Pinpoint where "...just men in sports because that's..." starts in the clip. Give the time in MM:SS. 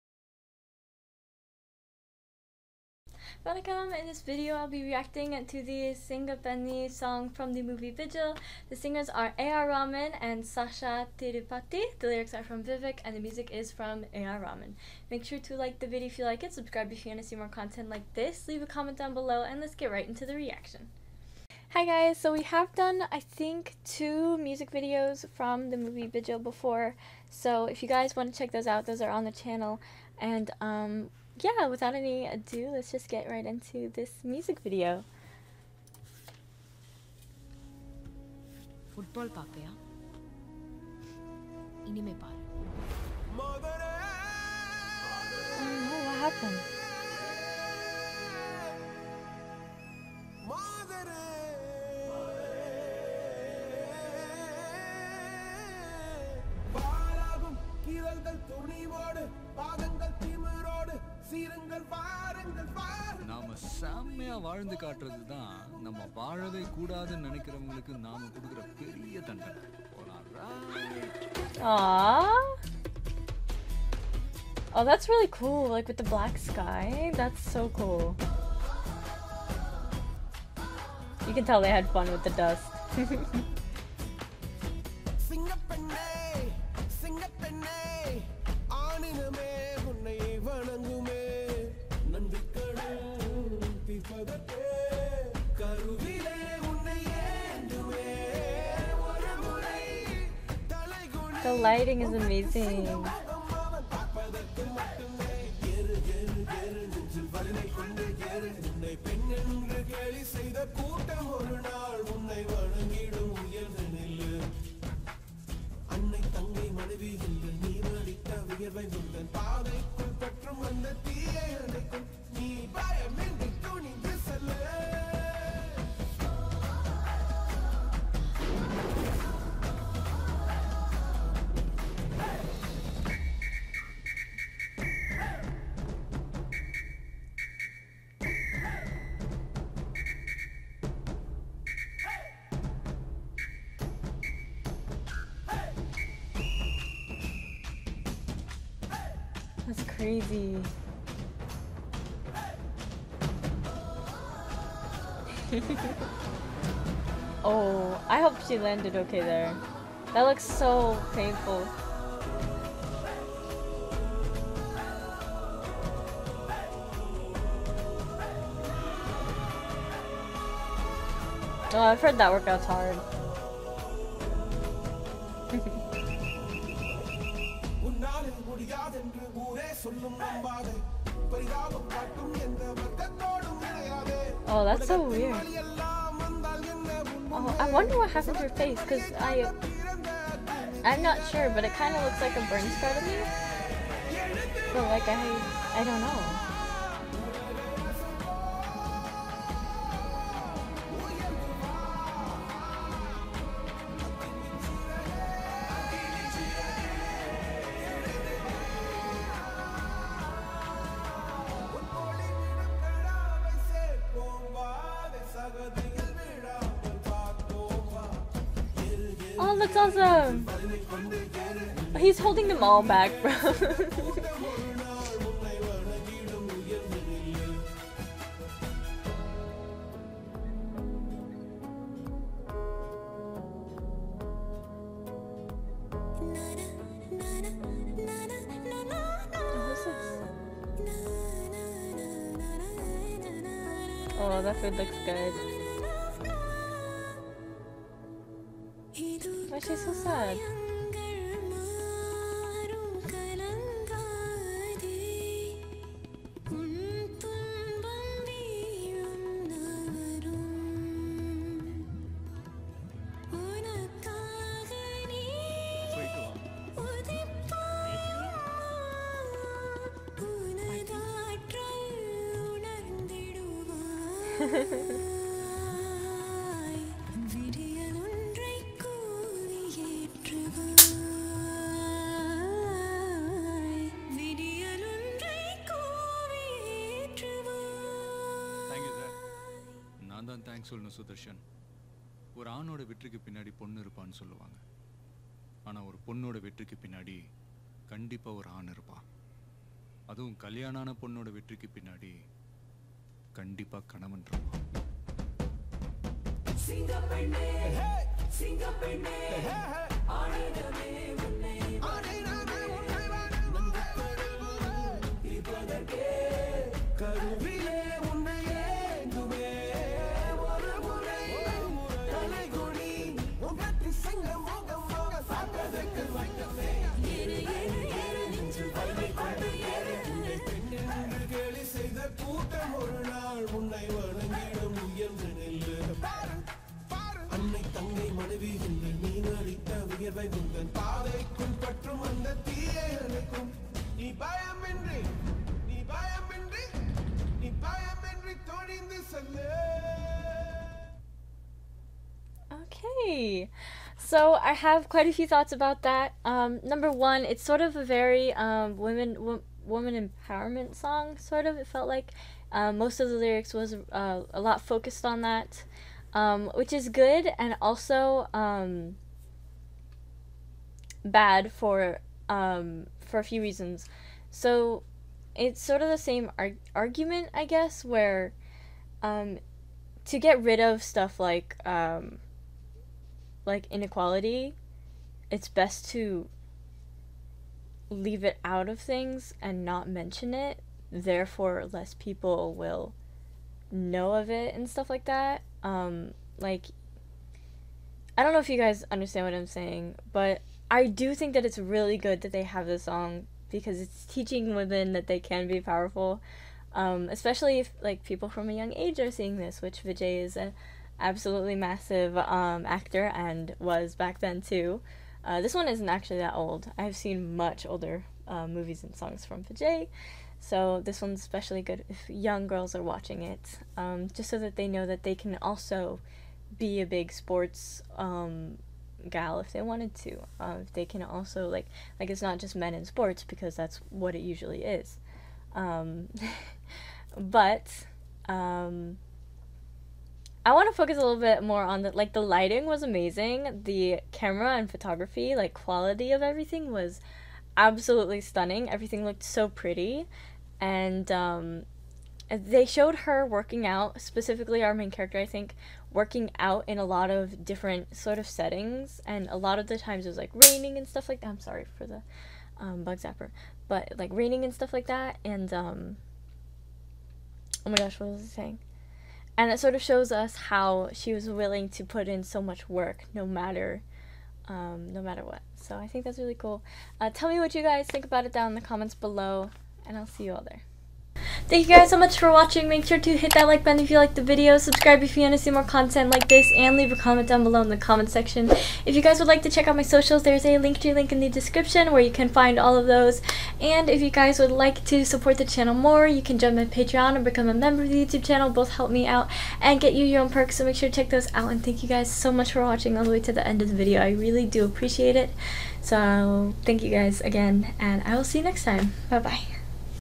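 07:12.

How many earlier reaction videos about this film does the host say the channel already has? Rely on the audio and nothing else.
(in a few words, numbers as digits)
2.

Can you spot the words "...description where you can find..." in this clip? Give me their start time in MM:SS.
08:11.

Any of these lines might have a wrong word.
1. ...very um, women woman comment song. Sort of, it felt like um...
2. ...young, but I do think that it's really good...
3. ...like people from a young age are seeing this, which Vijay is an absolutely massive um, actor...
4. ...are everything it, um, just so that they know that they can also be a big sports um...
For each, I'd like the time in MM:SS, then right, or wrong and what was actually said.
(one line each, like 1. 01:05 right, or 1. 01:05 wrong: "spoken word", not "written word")
1. 05:57 wrong: "empowerment", not "comment"
2. 06:39 wrong: "saying", not "young"
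3. 06:47 right
4. 07:02 wrong: "watching", not "everything".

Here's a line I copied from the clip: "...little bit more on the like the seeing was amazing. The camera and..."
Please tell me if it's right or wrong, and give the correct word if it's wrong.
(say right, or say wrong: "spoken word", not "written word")
wrong: "lighting", not "seeing".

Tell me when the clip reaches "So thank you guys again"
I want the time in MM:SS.
08:25.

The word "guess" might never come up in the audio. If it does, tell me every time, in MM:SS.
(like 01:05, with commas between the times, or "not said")
06:17.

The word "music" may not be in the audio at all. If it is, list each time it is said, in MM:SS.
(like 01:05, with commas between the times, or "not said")
00:13, 00:24, 00:34.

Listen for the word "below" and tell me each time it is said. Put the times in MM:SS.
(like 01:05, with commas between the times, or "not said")
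00:19, 07:58, 08:07.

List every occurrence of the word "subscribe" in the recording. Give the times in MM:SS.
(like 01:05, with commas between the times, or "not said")
00:16, 08:04.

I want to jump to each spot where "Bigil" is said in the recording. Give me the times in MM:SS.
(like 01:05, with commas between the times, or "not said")
00:07, 00:26.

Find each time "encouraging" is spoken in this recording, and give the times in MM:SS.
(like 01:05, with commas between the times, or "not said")
not said.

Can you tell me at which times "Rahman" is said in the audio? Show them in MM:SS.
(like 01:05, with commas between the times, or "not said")
00:09, 00:14.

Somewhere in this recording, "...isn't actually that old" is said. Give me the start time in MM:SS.
06:55.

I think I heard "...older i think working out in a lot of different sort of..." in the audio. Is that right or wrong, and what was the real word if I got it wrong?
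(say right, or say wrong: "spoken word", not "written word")
wrong: "character", not "older".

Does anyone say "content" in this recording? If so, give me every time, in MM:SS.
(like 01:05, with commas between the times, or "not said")
00:17, 08:05.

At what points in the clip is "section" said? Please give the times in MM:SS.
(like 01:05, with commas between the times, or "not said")
08:08.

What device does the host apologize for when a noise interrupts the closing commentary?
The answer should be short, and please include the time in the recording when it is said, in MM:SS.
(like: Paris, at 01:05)
Bug zapper, at 07:42.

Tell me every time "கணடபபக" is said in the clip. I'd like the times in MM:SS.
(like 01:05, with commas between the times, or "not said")
04:57, 05:03.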